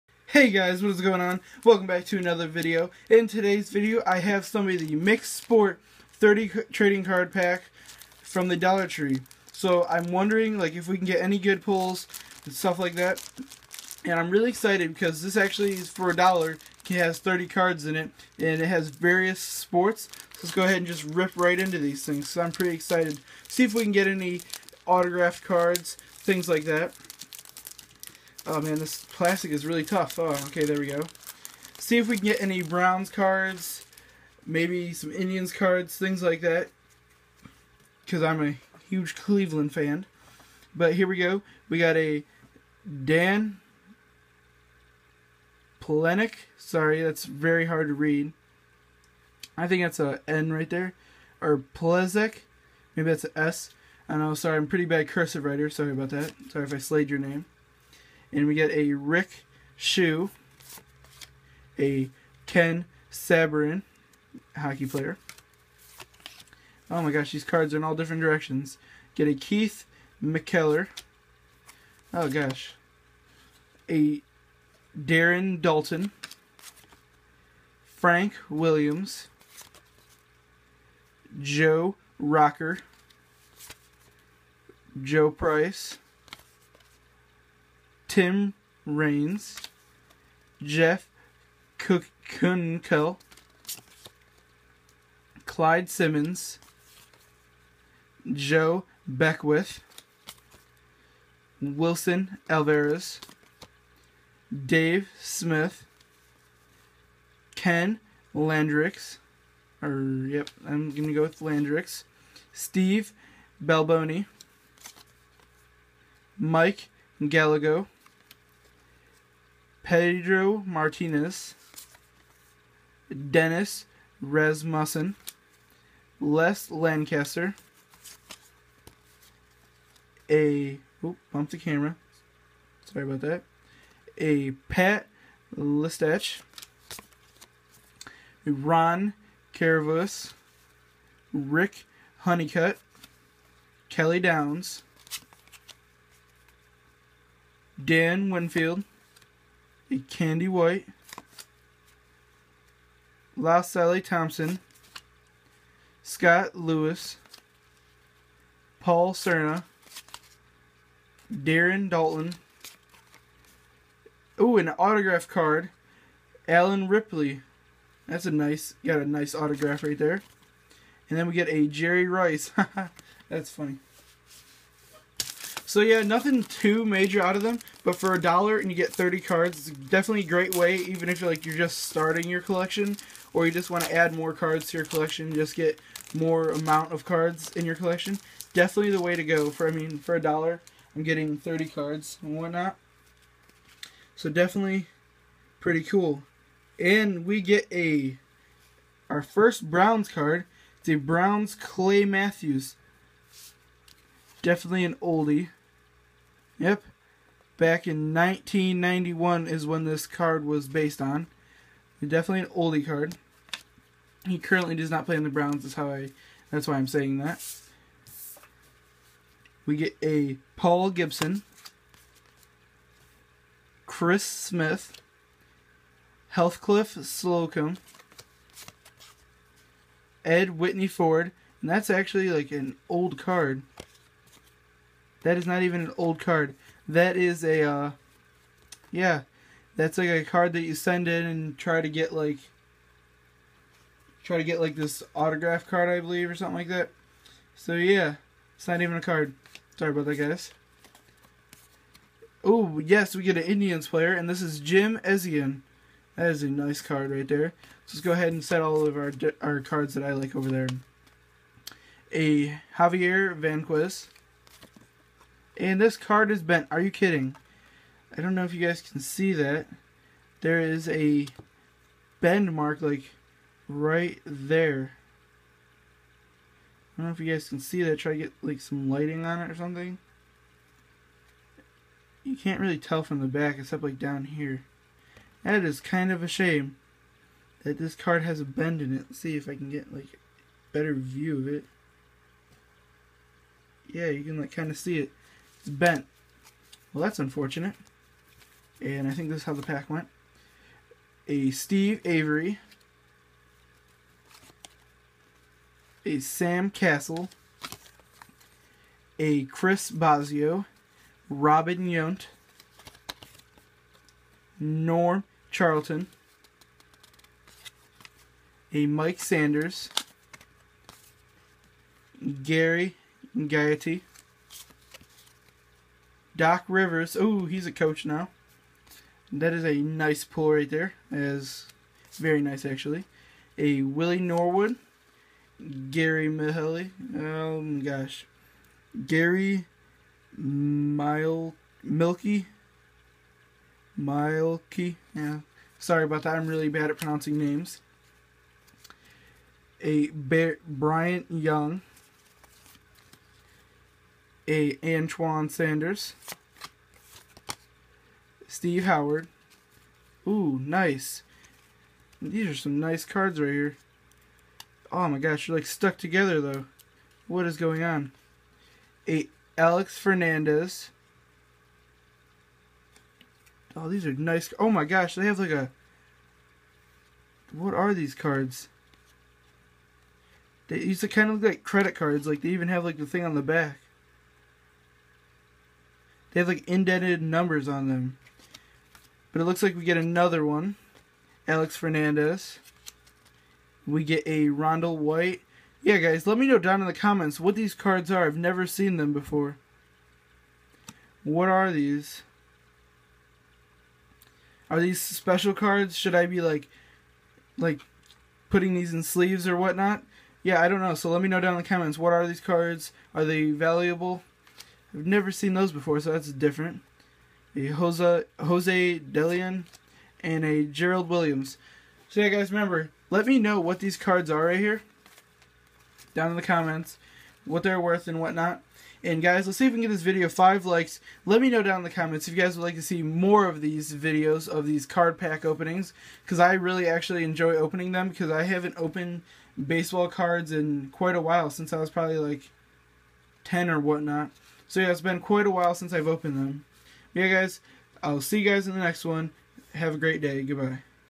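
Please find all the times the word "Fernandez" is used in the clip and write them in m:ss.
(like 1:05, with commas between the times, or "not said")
6:09, 6:31.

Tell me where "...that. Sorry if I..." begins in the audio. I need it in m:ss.
0:56.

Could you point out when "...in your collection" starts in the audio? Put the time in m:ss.
3:07.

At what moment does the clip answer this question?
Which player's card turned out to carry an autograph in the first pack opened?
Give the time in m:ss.
2:46.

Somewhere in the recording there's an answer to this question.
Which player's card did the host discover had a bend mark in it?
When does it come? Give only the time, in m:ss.
4:22.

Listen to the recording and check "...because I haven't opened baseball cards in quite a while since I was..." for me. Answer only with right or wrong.
right.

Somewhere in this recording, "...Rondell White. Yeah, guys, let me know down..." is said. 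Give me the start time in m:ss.
6:34.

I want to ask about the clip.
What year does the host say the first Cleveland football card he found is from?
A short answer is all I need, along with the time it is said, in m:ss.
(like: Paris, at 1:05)
1991, at 3:28.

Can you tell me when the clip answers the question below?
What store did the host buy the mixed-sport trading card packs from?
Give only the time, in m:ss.
0:08.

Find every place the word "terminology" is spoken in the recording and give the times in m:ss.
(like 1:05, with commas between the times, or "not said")
not said.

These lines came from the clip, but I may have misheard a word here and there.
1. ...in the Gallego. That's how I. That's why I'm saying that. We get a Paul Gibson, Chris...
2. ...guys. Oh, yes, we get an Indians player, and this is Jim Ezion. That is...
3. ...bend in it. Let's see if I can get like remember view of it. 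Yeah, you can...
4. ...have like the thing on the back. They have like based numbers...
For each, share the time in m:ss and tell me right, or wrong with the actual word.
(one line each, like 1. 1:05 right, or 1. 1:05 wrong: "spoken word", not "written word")
1. 3:35 wrong: "Browns", not "Gallego"
2. 4:10 right
3. 4:48 wrong: "better", not "remember"
4. 6:22 wrong: "indented", not "based".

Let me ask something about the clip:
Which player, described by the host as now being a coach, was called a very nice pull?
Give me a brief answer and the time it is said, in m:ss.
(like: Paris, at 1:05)
Doc Rivers, at 5:26.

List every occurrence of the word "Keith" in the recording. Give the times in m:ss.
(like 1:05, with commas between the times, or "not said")
1:09.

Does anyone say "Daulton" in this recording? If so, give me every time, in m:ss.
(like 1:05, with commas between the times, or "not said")
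1:15, 2:41.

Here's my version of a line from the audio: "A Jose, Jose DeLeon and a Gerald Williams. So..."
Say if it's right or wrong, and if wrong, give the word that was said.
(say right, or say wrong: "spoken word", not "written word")
right.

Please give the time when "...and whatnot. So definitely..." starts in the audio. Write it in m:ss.
3:12.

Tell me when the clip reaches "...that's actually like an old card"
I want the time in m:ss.
3:51.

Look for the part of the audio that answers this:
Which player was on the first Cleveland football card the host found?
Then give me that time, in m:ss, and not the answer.
3:21.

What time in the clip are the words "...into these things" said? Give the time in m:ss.
0:21.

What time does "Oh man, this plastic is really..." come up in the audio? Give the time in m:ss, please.
0:28.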